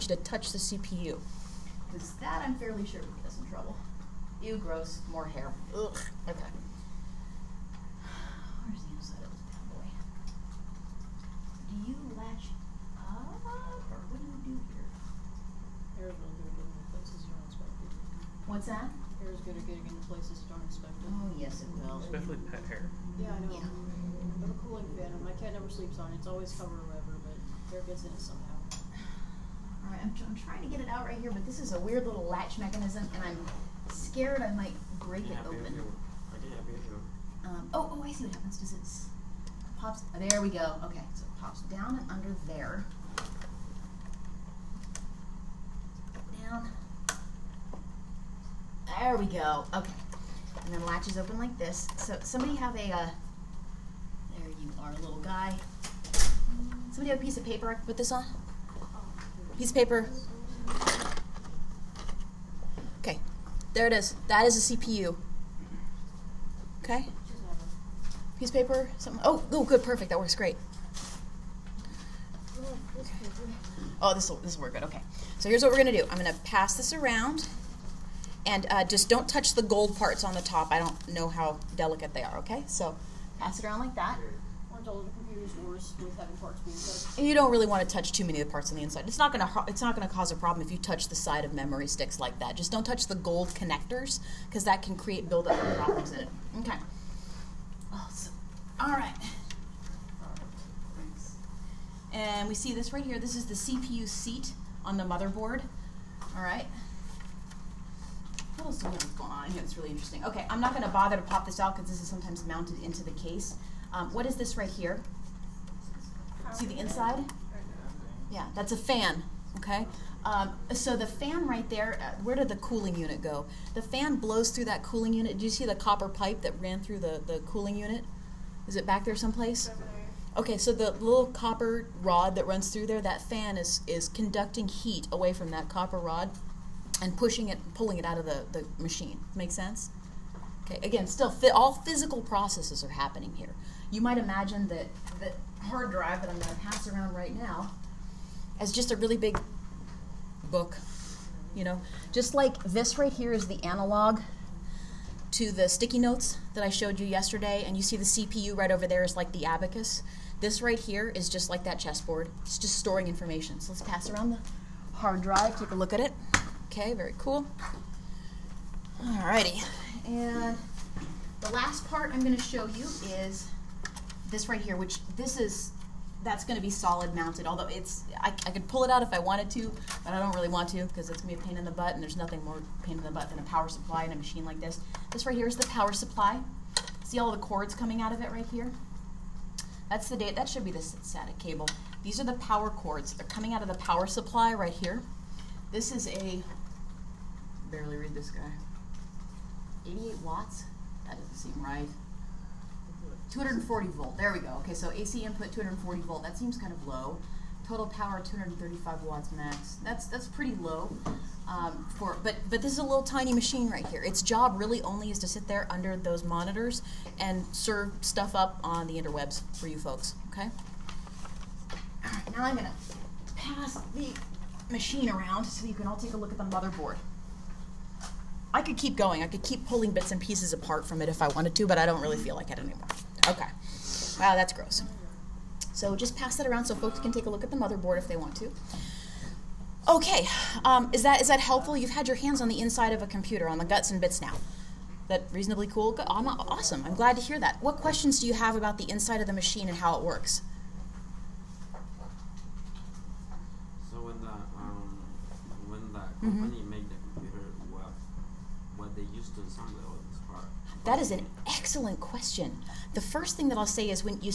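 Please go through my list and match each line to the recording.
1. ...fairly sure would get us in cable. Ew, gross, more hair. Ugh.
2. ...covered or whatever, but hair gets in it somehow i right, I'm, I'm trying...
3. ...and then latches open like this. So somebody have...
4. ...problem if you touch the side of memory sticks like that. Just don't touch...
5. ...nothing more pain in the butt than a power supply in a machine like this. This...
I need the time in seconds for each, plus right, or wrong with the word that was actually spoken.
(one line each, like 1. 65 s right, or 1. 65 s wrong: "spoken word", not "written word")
1. 2 s wrong: "trouble", not "cable"
2. 26 s right
3. 50 s right
4. 90 s right
5. 182 s right.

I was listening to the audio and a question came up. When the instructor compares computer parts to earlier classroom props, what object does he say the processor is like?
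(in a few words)
abacus.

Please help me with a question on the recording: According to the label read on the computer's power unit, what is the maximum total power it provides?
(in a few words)
235 watts.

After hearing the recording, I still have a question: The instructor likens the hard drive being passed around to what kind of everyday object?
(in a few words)
a really big book.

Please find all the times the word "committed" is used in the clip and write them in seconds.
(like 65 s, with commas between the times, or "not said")
not said.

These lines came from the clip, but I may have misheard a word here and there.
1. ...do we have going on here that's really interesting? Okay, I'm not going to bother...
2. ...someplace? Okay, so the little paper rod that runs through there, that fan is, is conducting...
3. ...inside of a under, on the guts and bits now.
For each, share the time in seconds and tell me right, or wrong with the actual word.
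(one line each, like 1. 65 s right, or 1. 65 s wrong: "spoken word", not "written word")
1. 108 s right
2. 129 s wrong: "copper", not "paper"
3. 242 s wrong: "computer", not "under".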